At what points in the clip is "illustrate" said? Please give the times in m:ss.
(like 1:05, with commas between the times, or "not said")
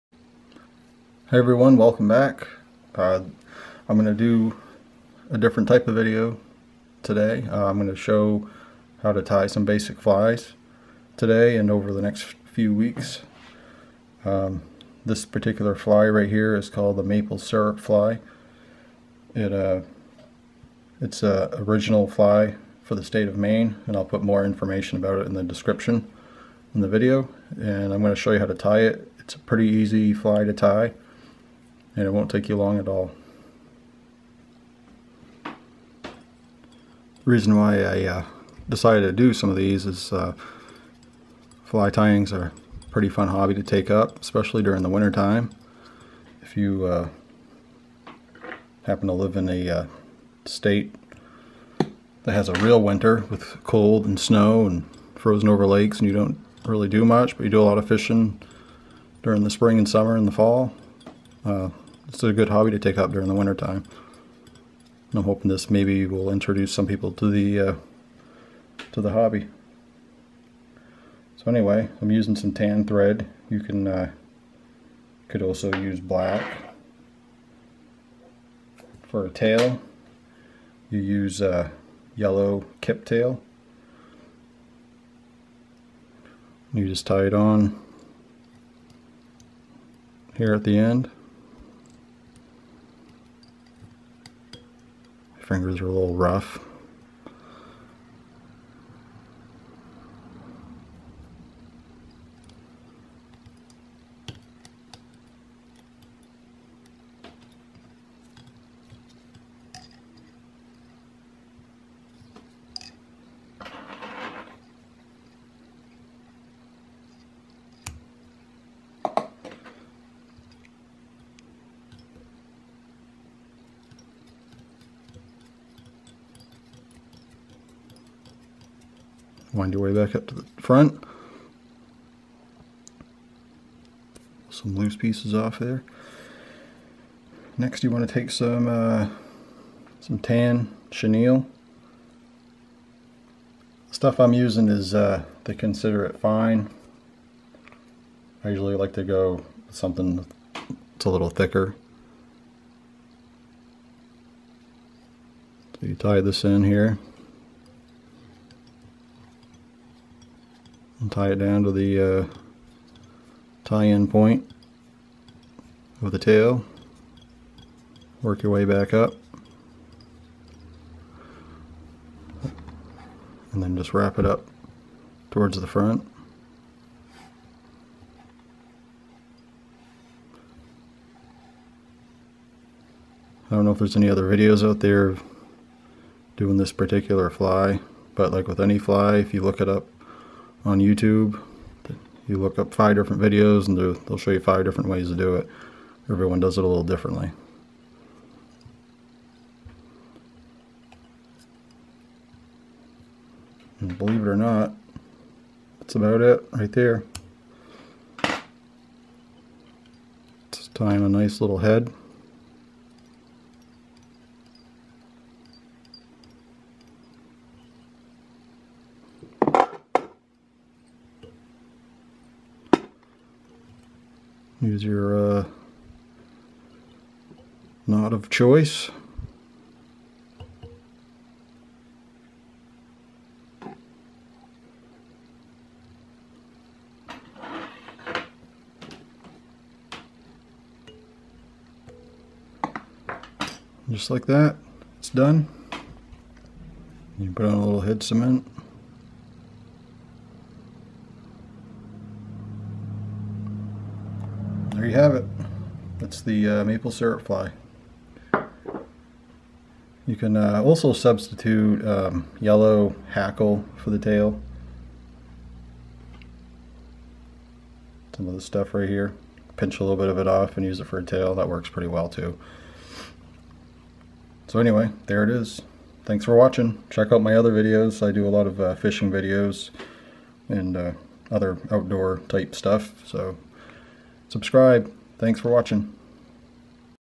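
not said.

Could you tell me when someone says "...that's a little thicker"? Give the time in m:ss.
2:30.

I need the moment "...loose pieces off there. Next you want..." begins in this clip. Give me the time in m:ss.
2:14.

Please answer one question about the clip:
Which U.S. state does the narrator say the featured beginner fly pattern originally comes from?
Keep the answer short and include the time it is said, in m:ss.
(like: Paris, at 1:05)
Maine, at 0:23.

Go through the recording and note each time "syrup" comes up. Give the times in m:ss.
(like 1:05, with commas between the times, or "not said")
0:17, 4:16.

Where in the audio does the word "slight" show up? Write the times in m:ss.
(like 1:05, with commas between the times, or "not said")
not said.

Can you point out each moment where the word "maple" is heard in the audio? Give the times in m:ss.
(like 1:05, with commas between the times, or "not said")
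0:17, 4:16.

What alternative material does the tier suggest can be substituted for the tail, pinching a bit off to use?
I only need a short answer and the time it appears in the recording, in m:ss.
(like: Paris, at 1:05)
Yellow hackle, at 4:22.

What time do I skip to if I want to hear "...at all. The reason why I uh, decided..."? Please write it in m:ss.
0:32.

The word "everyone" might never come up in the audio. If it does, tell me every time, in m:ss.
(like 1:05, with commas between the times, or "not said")
0:01, 3:16.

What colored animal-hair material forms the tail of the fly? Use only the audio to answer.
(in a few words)
Yellow kip tail.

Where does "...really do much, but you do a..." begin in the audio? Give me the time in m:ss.
0:56.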